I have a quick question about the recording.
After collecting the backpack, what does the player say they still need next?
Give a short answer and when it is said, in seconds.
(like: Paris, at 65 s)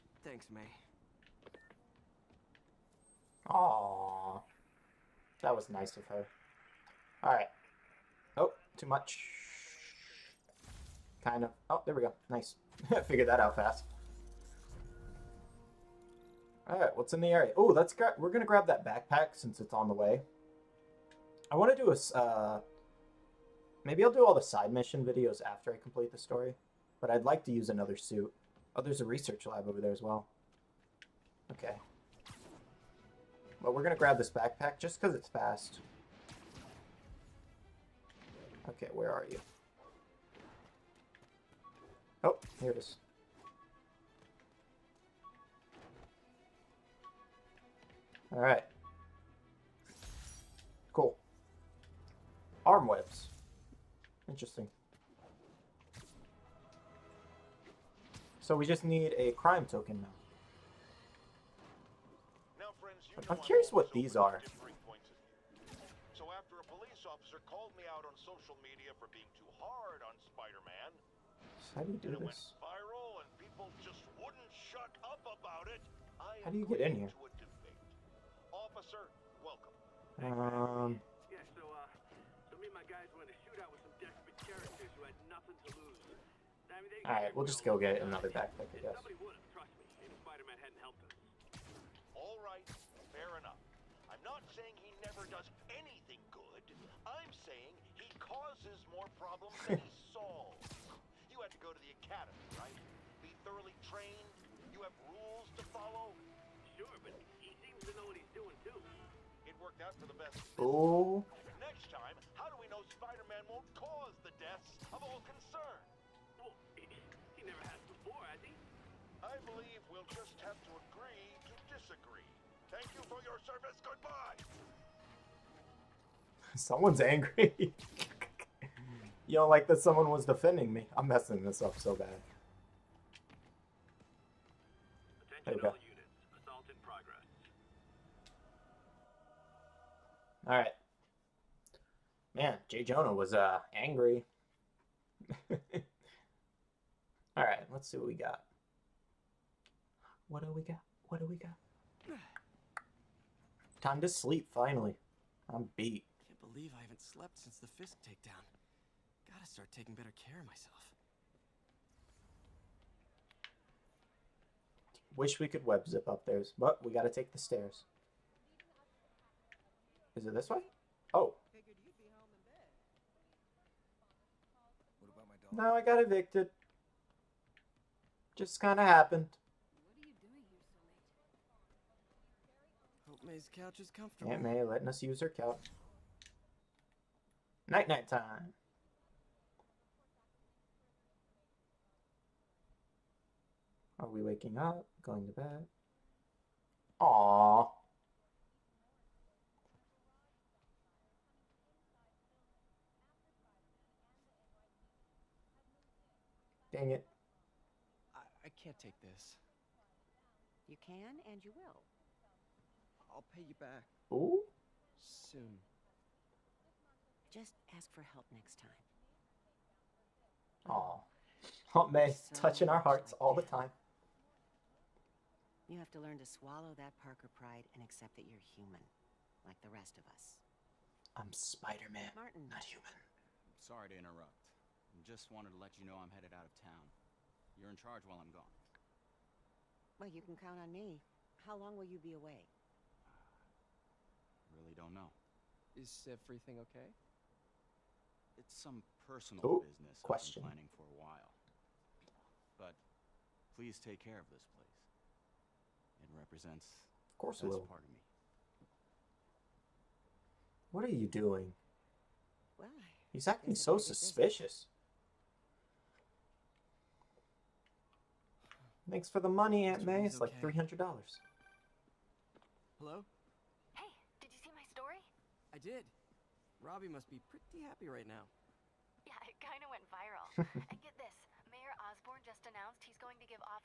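A crime token, at 59 s.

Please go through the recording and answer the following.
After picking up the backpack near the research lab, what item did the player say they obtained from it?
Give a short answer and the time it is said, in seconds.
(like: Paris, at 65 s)
Arm webs, at 52 s.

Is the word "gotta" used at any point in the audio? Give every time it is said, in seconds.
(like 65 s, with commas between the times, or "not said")
159 s, 166 s.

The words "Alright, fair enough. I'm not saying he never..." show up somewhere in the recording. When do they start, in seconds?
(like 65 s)
92 s.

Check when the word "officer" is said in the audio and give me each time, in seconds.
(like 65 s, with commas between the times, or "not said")
67 s, 78 s.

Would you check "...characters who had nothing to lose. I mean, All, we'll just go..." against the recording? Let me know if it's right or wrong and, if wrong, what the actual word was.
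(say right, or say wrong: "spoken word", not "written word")
wrong: "Alright", not "All".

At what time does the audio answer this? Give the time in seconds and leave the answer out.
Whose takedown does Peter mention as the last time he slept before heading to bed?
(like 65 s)
157 s.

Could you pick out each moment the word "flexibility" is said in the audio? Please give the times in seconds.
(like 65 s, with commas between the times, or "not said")
not said.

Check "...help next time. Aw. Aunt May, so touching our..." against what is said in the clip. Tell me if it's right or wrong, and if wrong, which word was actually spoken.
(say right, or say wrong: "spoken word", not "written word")
right.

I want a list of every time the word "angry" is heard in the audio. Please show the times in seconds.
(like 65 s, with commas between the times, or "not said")
126 s, 143 s.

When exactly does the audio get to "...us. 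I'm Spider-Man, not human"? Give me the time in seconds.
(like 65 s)
230 s.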